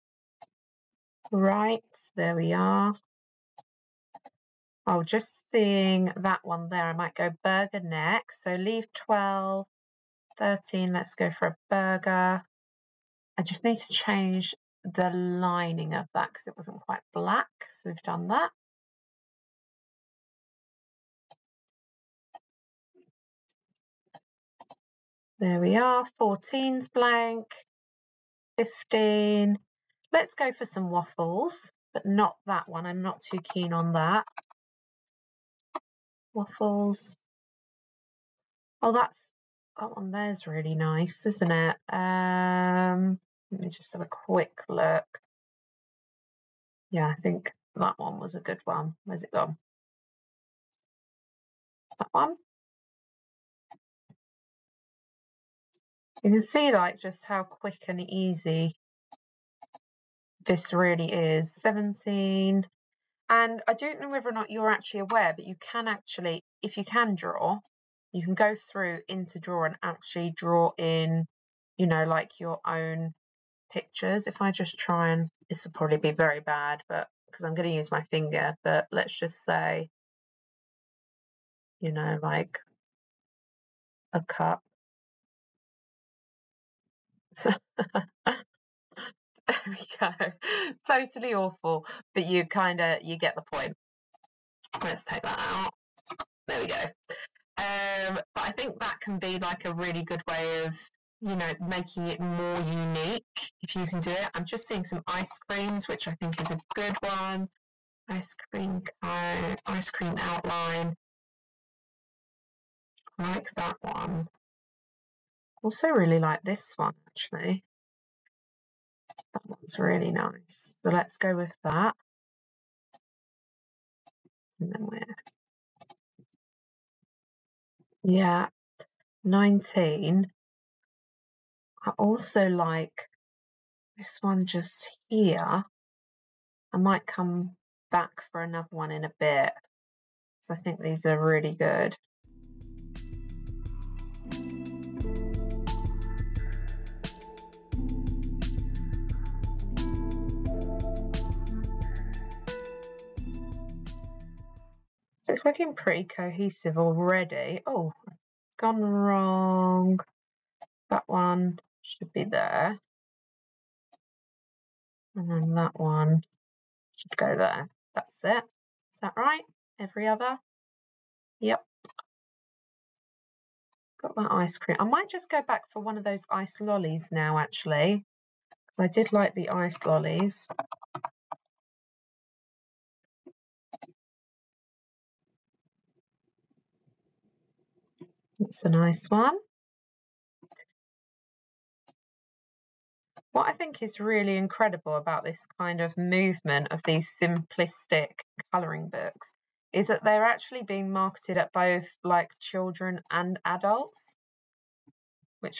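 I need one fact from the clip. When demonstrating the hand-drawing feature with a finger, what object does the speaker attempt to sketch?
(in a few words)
cup.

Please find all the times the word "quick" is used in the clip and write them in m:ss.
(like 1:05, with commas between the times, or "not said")
0:44, 0:57.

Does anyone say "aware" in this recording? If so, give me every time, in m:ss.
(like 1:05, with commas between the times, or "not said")
1:05.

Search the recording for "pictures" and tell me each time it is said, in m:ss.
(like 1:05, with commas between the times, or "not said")
1:13.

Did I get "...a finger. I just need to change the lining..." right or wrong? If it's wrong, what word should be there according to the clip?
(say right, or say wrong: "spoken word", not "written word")
wrong: "burger", not "finger".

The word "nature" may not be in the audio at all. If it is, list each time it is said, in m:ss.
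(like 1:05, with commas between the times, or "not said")
not said.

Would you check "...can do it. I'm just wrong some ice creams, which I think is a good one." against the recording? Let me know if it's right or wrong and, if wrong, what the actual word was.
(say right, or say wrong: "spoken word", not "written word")
wrong: "seeing", not "wrong".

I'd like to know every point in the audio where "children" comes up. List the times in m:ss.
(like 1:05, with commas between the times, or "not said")
3:22.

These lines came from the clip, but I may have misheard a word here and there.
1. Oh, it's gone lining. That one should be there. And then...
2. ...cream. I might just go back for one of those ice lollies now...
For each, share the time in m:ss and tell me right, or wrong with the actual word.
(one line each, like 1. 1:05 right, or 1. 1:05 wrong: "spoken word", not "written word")
1. 2:37 wrong: "wrong", not "lining"
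2. 2:54 right.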